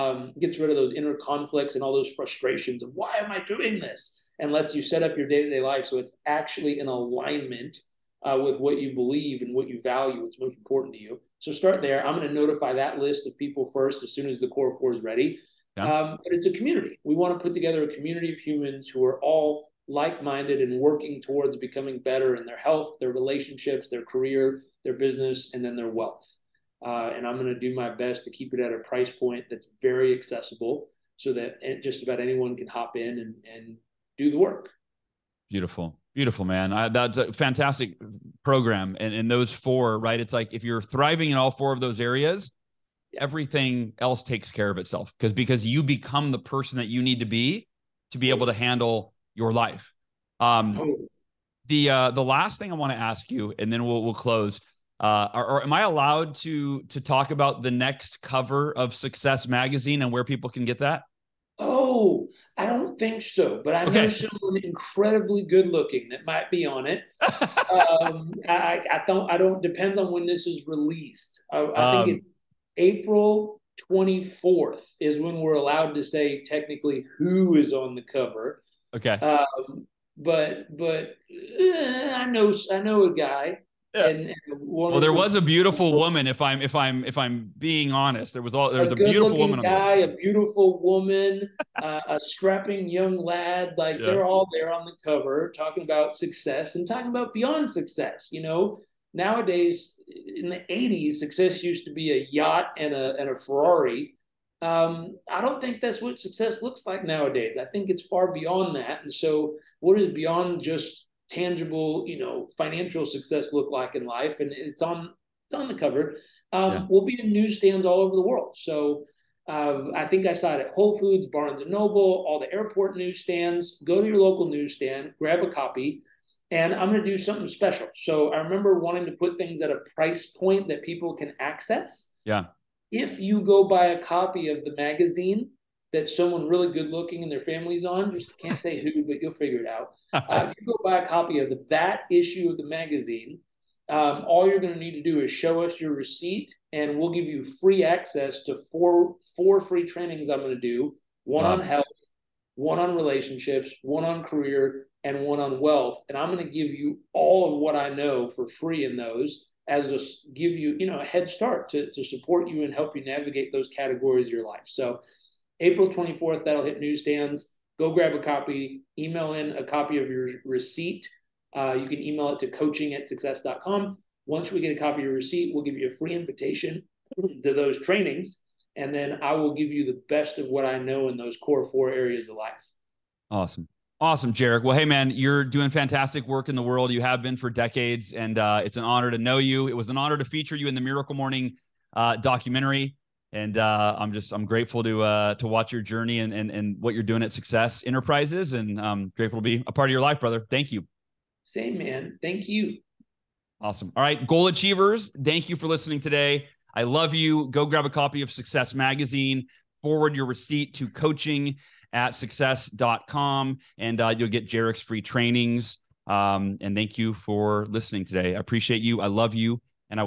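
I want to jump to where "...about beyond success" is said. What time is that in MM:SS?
01:37.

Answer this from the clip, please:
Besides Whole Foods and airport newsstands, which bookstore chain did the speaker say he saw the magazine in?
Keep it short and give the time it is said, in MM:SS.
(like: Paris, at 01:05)
Barnes and Noble, at 02:01.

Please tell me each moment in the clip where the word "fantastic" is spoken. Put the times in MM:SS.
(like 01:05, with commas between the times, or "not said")
00:37, 03:05.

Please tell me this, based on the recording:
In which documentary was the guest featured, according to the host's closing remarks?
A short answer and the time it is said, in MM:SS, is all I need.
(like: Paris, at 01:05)
Miracle Morning, at 03:10.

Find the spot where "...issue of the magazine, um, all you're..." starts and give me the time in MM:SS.
02:22.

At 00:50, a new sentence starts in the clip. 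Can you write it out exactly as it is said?
Um, the uh, the last thing I want to ask you, and then we'll we'll close.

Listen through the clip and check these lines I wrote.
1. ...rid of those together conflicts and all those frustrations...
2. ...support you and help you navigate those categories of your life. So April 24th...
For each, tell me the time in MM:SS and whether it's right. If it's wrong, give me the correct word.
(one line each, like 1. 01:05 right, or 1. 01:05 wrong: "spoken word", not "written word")
1. 00:00 wrong: "inner", not "together"
2. 02:42 right.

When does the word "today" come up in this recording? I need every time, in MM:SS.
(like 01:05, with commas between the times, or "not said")
03:26, 03:38.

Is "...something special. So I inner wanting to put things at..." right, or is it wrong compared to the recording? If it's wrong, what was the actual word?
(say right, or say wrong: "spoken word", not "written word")
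wrong: "remember", not "inner".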